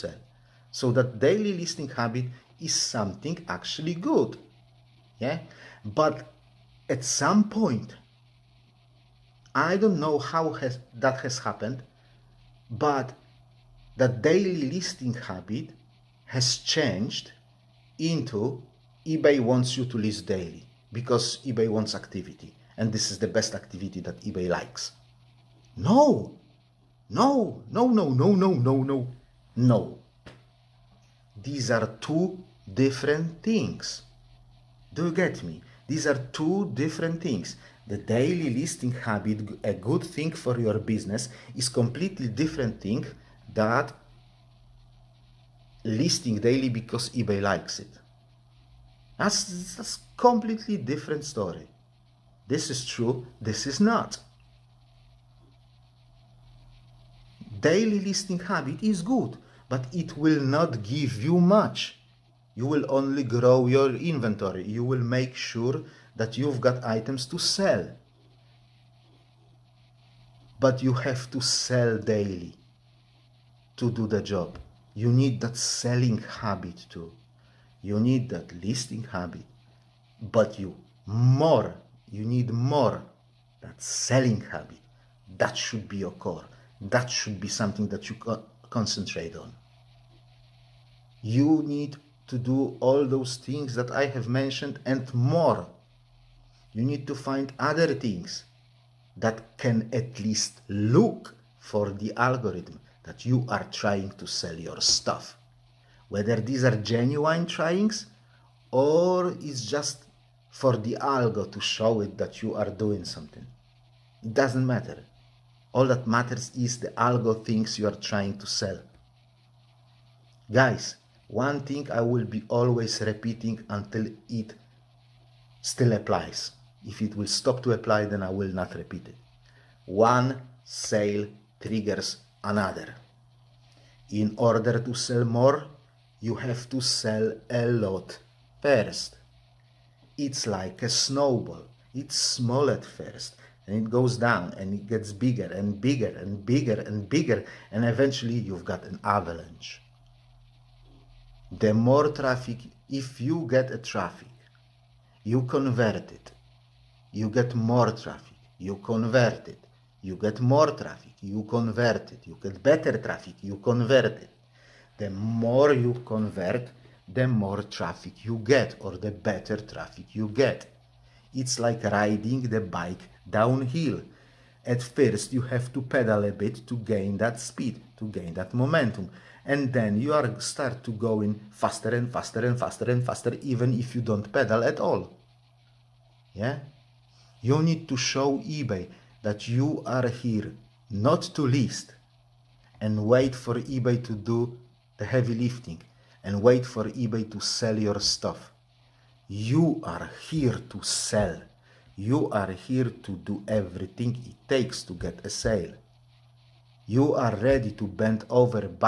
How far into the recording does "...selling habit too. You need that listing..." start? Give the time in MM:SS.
01:15.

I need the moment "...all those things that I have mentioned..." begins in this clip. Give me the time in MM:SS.
01:32.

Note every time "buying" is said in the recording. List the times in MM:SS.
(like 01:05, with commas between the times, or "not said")
not said.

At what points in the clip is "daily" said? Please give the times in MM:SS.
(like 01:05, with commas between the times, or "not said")
00:01, 00:14, 00:20, 00:37, 00:46, 00:57, 01:11.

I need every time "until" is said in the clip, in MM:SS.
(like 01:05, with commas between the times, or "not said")
02:03.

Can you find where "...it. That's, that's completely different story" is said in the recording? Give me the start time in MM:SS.
00:47.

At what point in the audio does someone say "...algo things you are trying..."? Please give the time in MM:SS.
01:56.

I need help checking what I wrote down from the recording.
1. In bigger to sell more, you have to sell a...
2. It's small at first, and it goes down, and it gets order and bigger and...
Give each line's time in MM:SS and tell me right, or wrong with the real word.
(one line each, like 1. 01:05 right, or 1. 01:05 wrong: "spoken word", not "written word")
1. 02:14 wrong: "order", not "bigger"
2. 02:21 wrong: "bigger", not "order".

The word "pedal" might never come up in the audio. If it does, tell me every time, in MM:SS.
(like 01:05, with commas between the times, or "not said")
02:55, 03:04.